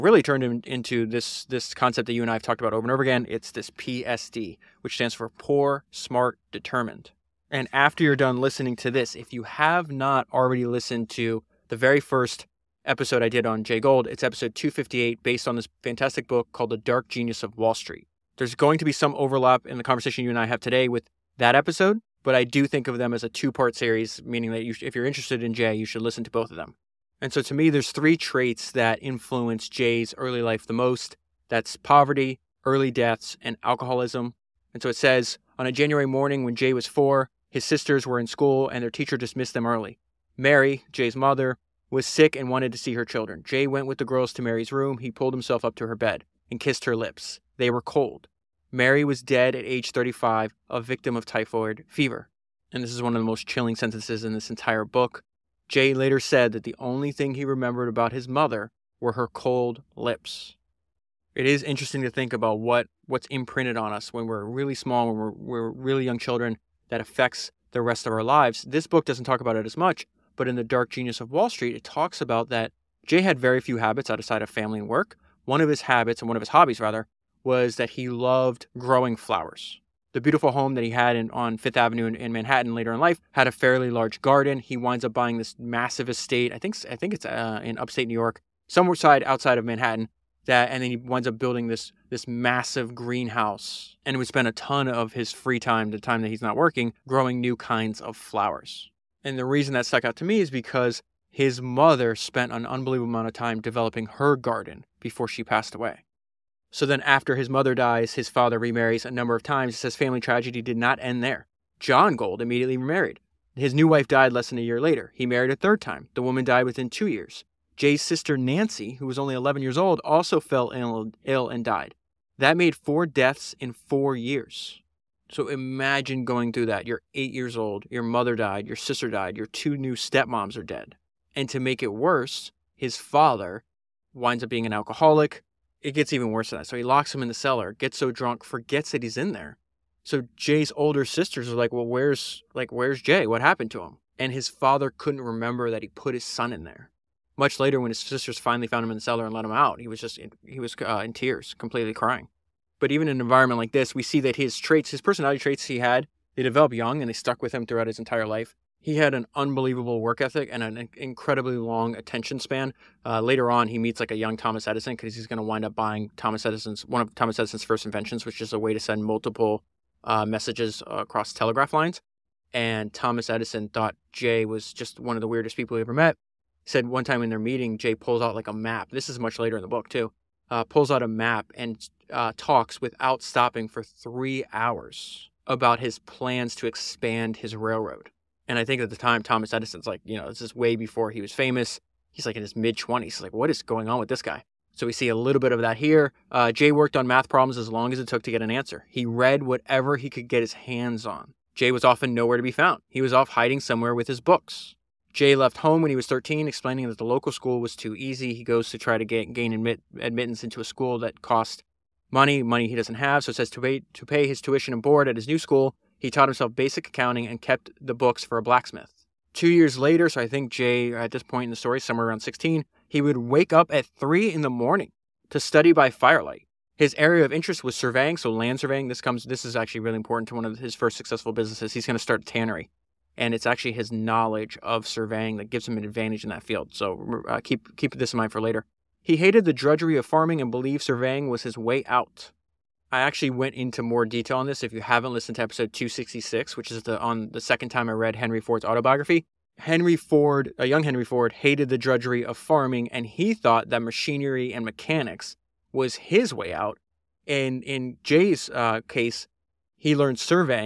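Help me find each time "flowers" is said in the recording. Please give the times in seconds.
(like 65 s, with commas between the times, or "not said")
79 s, 98 s.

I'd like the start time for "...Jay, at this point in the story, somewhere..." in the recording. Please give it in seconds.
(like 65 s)
220 s.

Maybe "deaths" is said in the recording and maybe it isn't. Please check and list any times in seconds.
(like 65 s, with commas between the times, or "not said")
32 s, 123 s.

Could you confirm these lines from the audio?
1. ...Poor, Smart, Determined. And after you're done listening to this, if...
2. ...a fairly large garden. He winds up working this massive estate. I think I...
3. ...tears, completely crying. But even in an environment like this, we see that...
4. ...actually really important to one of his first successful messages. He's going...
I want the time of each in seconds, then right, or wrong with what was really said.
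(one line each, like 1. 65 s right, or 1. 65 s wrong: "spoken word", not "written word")
1. 5 s right
2. 83 s wrong: "buying", not "working"
3. 151 s right
4. 229 s wrong: "businesses", not "messages".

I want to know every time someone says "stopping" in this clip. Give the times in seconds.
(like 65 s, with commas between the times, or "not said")
183 s.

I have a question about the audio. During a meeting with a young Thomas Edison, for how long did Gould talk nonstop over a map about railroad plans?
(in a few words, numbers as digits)
3 hours.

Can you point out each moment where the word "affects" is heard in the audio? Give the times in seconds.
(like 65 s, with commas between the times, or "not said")
67 s.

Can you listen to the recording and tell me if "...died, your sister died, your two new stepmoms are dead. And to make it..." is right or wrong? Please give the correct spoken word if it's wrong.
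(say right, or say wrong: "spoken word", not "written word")
right.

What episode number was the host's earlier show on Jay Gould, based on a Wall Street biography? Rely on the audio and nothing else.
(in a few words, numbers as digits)
258.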